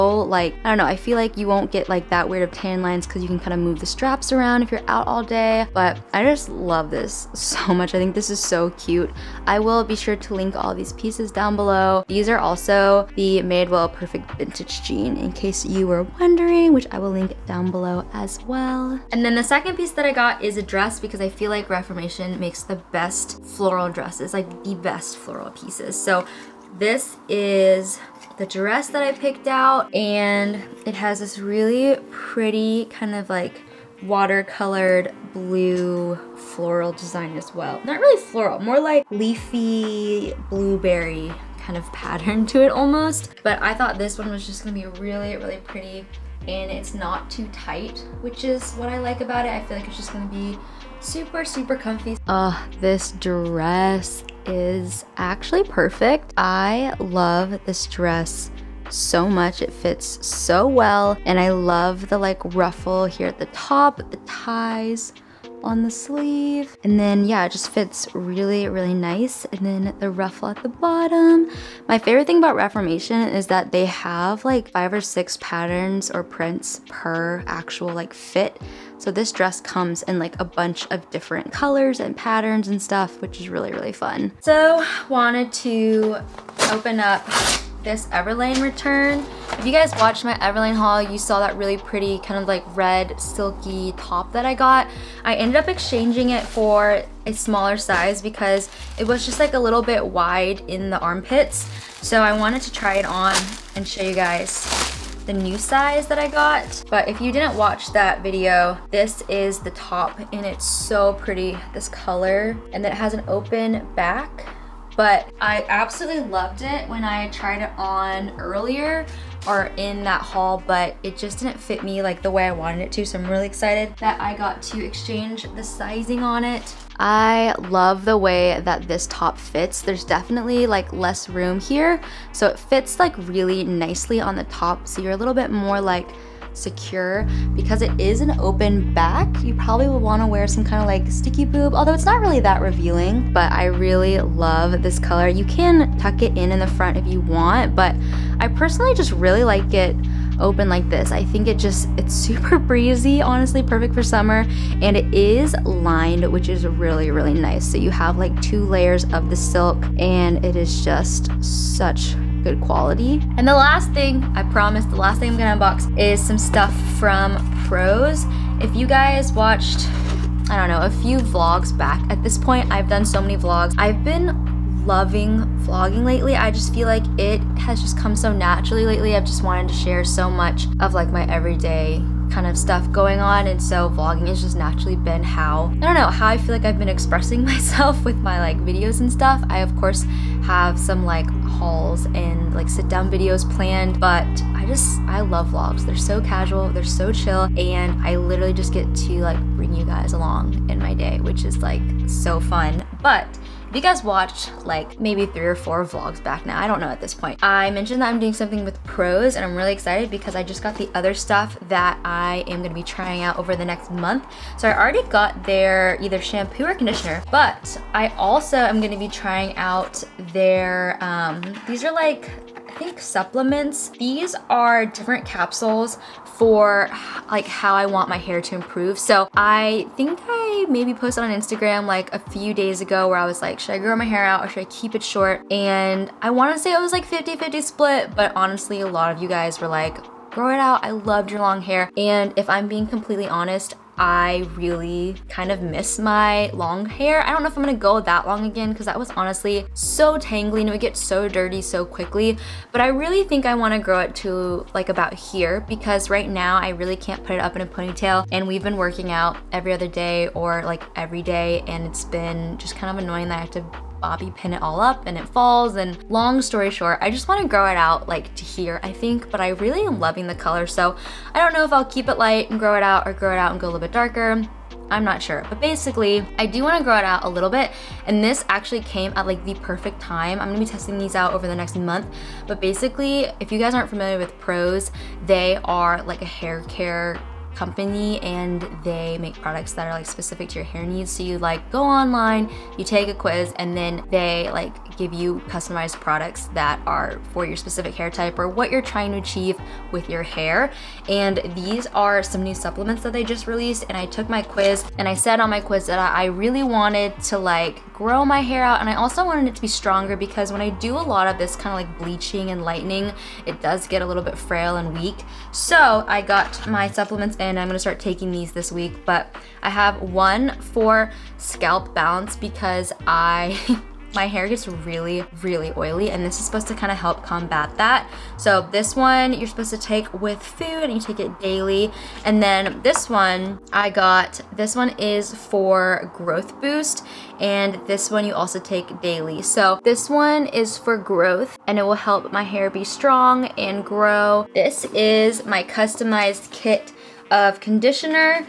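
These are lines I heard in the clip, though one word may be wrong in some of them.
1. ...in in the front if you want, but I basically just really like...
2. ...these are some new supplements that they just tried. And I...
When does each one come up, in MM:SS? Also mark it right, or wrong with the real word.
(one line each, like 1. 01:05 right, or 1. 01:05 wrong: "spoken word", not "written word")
1. 02:26 wrong: "personally", not "basically"
2. 05:01 wrong: "released", not "tried".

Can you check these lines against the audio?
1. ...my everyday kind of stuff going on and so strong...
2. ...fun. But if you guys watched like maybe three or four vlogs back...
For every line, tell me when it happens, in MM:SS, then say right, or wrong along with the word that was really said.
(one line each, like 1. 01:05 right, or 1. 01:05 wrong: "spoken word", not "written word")
1. 03:01 wrong: "vlogging", not "strong"
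2. 03:22 right.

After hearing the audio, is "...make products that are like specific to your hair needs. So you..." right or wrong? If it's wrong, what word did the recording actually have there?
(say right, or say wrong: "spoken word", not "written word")
right.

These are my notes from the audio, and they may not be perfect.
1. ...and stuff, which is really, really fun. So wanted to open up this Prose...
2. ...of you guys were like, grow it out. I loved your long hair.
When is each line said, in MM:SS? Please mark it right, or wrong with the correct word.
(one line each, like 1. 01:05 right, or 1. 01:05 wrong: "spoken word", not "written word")
1. 01:22 wrong: "Everlane", not "Prose"
2. 03:59 right.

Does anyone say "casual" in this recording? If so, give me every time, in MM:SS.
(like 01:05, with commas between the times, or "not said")
03:16.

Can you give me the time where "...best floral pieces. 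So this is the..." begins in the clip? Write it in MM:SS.
00:24.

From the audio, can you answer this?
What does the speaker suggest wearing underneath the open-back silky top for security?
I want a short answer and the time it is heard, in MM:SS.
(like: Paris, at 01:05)
sticky boob, at 02:21.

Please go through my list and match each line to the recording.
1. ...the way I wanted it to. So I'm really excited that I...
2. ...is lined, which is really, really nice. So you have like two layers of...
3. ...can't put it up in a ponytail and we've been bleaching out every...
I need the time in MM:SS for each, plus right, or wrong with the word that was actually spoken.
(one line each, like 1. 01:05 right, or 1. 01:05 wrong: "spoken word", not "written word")
1. 02:02 right
2. 02:35 right
3. 04:16 wrong: "working", not "bleaching".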